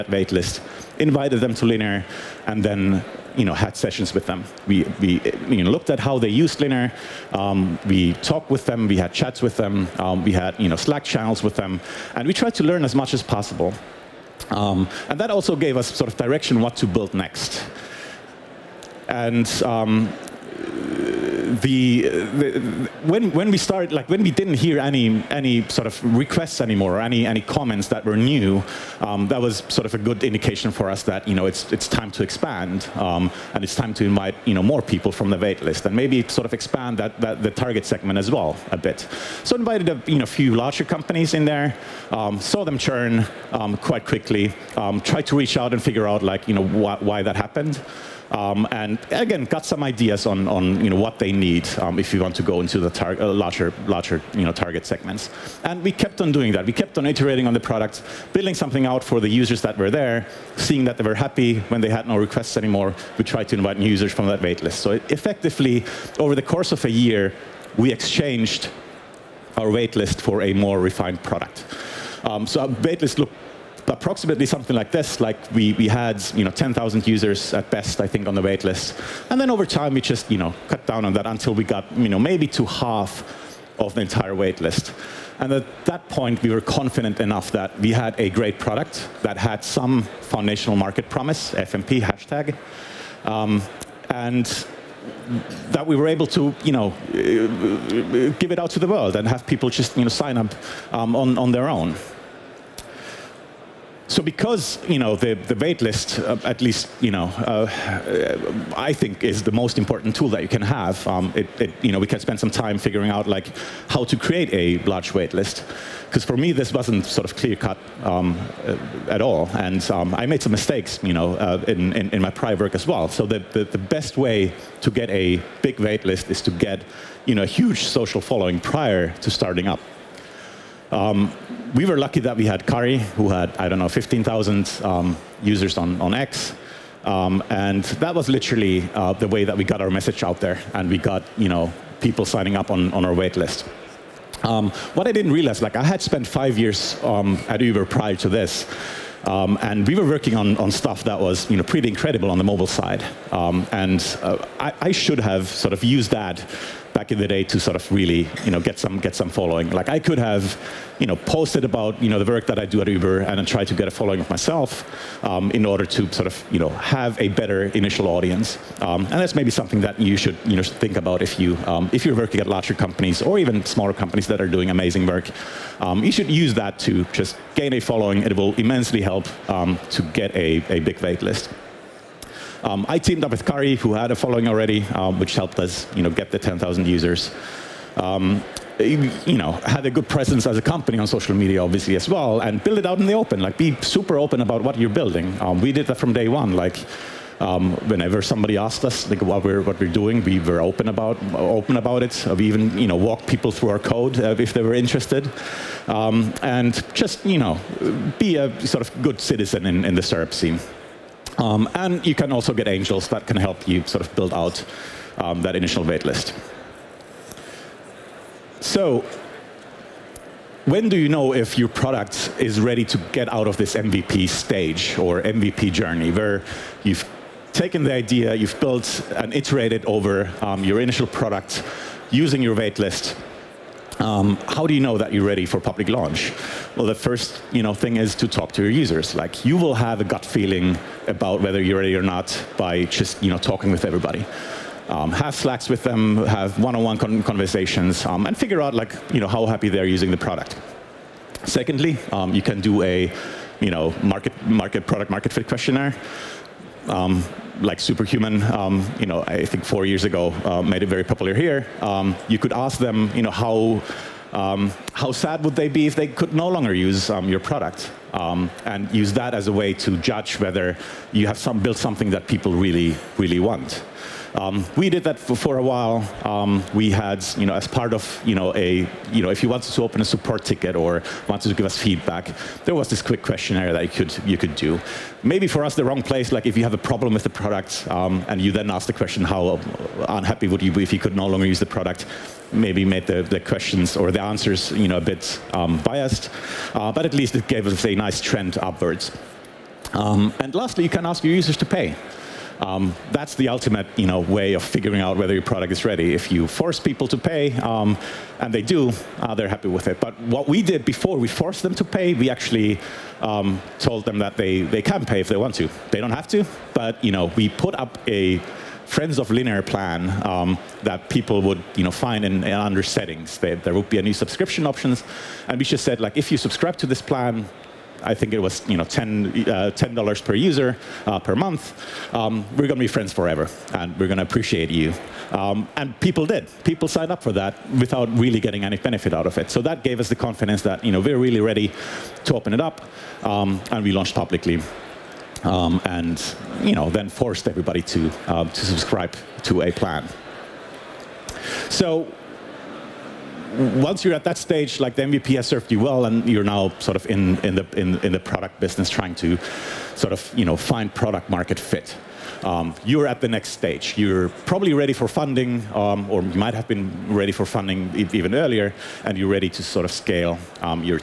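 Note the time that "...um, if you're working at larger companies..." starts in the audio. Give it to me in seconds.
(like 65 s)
171 s.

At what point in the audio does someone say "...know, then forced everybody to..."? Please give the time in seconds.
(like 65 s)
346 s.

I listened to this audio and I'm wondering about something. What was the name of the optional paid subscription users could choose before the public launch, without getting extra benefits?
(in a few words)
Friends of Linear.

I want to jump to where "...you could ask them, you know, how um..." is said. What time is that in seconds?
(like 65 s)
262 s.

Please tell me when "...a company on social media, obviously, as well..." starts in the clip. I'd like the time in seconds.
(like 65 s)
190 s.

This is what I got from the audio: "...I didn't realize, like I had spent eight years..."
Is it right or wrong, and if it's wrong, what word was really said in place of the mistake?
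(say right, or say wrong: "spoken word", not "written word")
wrong: "five", not "eight".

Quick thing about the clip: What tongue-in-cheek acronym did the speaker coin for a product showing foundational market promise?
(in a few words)
FMP.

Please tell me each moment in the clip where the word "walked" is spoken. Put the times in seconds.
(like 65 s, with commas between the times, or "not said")
202 s.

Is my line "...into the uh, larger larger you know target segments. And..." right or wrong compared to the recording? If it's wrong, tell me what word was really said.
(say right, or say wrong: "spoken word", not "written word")
right.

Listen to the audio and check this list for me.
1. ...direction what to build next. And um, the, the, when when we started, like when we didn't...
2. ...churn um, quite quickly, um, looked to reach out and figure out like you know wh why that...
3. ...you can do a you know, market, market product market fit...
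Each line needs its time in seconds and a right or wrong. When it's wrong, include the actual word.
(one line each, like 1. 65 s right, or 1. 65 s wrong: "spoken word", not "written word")
1. 16 s right
2. 42 s wrong: "tried", not "looked"
3. 252 s right.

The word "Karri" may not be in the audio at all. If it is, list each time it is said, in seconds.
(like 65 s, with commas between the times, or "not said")
132 s, 183 s.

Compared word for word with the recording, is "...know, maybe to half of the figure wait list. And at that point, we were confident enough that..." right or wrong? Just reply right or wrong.
wrong.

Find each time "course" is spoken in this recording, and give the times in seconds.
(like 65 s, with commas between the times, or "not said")
66 s.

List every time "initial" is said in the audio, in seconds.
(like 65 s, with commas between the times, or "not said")
167 s, 215 s, 230 s.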